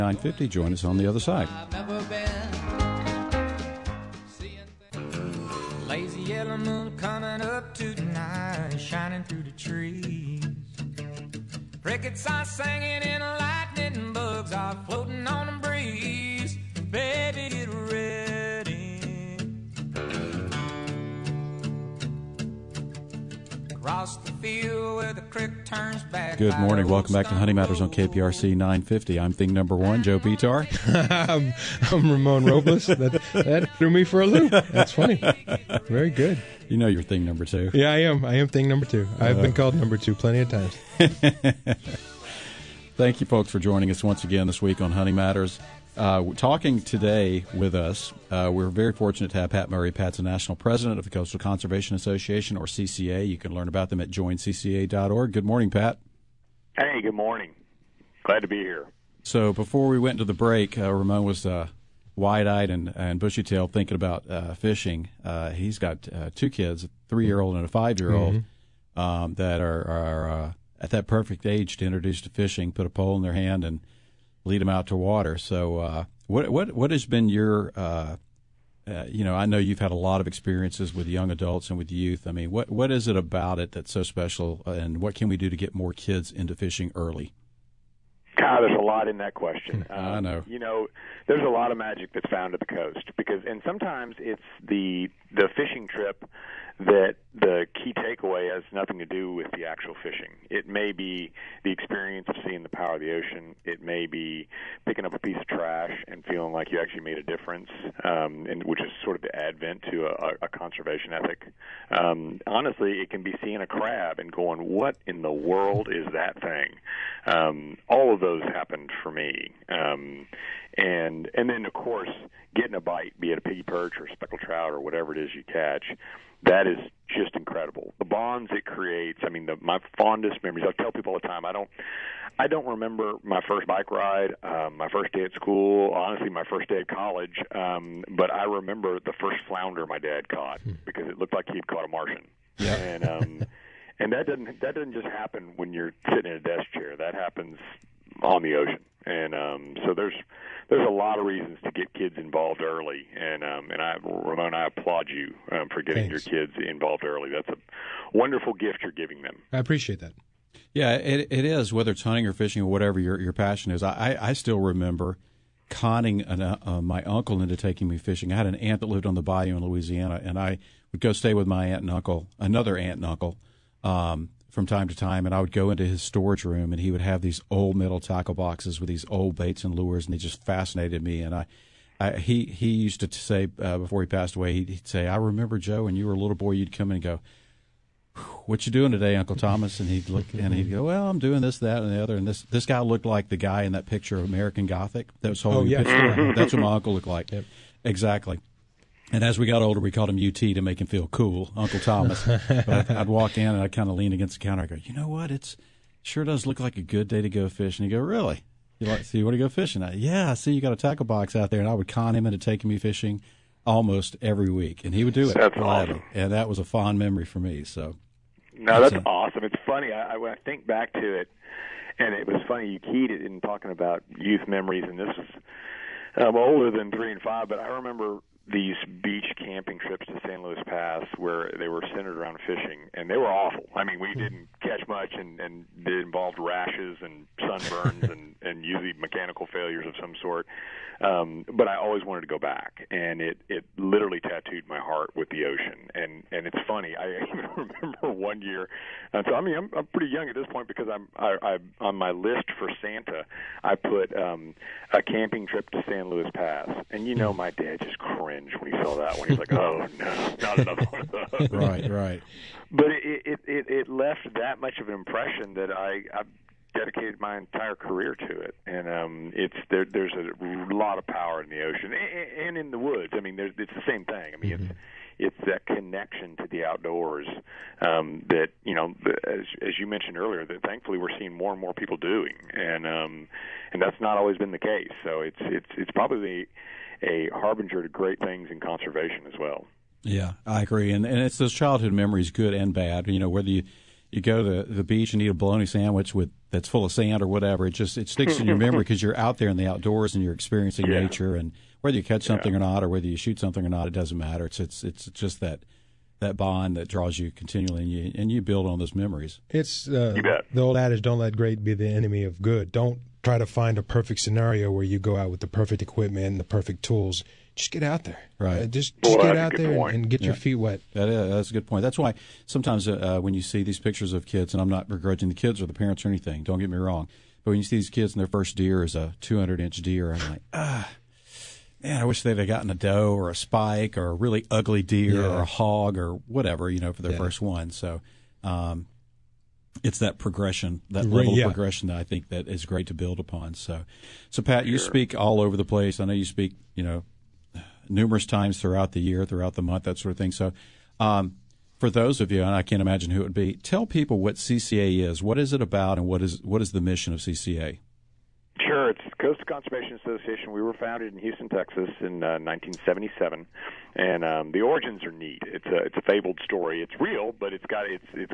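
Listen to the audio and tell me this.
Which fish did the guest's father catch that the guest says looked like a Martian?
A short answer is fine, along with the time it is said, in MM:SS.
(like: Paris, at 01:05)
Flounder, at 02:19.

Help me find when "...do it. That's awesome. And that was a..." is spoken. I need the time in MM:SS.
03:35.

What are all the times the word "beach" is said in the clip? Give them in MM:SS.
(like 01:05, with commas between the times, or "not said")
03:49, 04:54.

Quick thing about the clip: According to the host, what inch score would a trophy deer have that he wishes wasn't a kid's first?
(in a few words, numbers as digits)
200.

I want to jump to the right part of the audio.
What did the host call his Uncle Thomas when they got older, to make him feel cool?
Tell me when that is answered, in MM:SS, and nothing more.
03:20.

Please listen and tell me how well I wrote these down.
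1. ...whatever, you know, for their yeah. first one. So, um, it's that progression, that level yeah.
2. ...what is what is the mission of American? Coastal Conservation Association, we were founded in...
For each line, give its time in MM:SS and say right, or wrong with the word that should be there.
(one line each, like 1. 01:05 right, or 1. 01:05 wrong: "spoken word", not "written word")
1. 05:36 right
2. 05:56 wrong: "CCA", not "American".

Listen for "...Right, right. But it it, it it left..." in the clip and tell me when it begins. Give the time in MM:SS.
04:21.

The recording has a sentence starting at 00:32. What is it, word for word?
that, that, threw me for a loop.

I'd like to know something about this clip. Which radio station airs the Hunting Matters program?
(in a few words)
KPRC 950.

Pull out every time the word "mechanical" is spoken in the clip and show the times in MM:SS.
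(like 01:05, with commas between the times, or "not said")
03:58.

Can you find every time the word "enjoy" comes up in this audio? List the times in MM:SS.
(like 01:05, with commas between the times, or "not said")
not said.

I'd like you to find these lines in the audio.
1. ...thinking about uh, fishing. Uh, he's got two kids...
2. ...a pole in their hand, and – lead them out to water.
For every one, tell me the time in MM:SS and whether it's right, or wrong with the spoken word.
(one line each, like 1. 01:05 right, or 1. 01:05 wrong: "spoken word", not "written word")
1. 01:03 right
2. 01:12 right.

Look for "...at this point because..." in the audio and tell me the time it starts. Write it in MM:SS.
04:10.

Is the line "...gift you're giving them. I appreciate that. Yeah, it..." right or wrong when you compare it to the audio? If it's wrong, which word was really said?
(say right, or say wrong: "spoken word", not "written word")
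right.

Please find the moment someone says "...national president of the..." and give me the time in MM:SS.
00:50.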